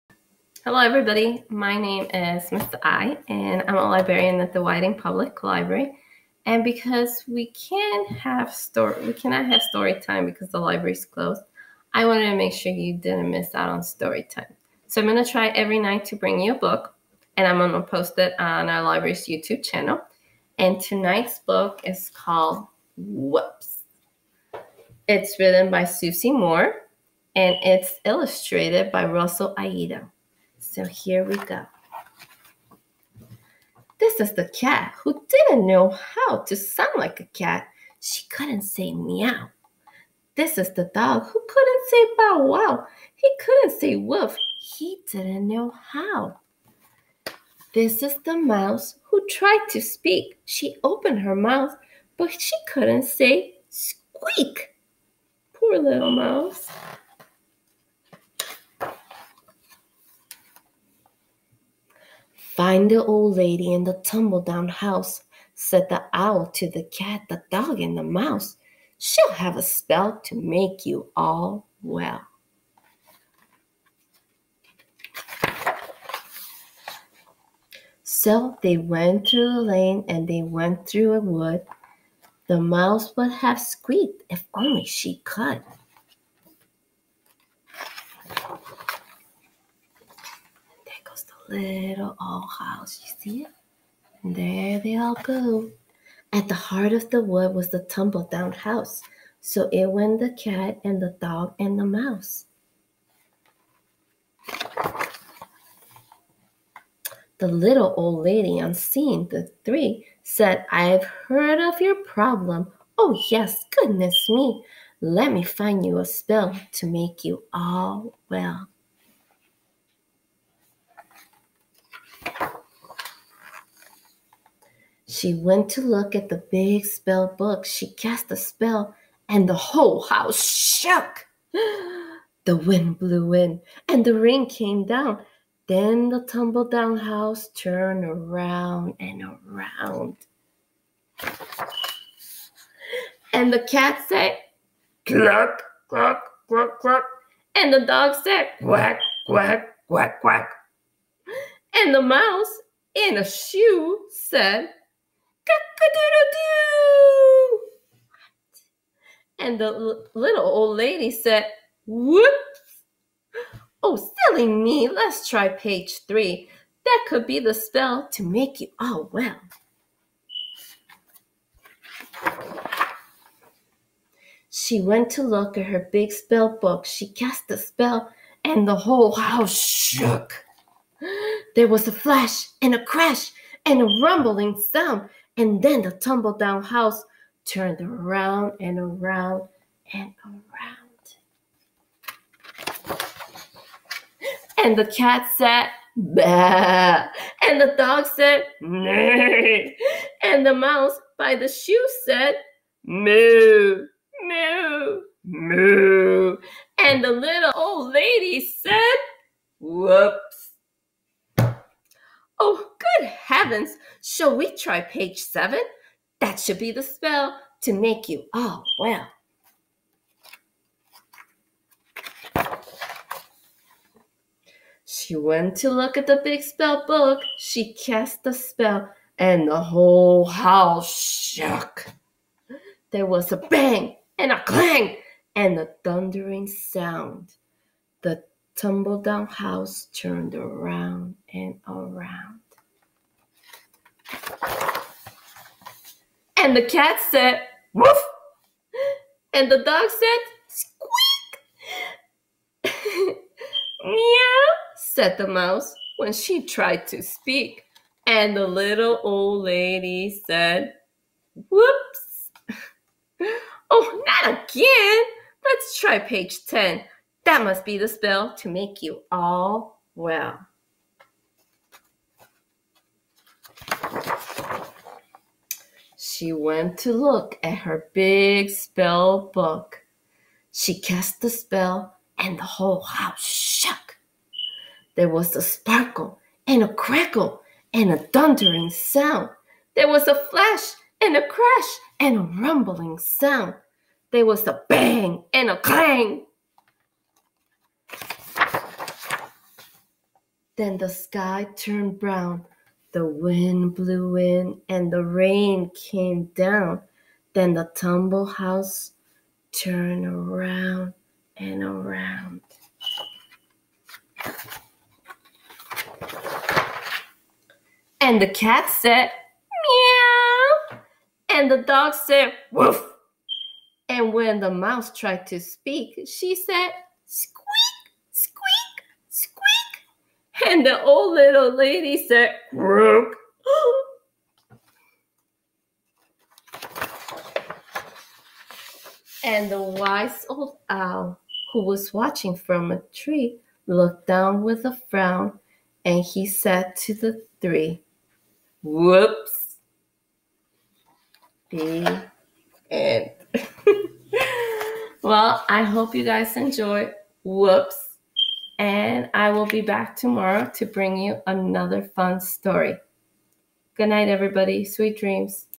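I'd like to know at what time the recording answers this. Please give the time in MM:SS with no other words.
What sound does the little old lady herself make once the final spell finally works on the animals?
05:32.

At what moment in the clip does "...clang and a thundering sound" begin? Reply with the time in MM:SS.
03:54.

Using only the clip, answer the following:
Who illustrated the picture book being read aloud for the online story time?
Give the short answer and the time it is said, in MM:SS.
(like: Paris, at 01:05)
Russell Ayto, at 00:29.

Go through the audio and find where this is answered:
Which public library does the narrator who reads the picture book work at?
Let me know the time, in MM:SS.
00:04.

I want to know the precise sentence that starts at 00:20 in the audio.
And tonight's book is called Whoops.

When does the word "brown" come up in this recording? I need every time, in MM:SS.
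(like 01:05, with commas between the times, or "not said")
05:01.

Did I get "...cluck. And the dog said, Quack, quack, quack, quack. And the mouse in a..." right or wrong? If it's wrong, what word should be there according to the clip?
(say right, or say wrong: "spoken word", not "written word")
right.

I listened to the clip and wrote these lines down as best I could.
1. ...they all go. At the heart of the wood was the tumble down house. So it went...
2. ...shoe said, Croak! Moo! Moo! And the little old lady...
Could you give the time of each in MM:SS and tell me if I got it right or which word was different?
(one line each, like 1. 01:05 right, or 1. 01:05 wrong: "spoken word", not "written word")
1. 01:34 right
2. 03:21 wrong: "Moo", not "Croak".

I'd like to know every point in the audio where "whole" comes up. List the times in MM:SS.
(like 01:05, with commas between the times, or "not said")
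02:09, 02:58, 03:49, 04:42.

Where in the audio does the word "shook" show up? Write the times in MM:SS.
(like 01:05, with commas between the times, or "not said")
02:10, 02:59, 03:50, 04:43.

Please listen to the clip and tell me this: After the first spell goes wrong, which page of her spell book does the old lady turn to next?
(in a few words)
3.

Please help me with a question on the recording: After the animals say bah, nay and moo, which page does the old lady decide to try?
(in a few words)
7.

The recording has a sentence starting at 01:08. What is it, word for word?
She'll have a spell to make you all well.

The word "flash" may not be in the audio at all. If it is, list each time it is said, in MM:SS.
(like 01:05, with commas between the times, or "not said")
03:01, 04:50.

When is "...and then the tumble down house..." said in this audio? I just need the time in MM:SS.
03:05.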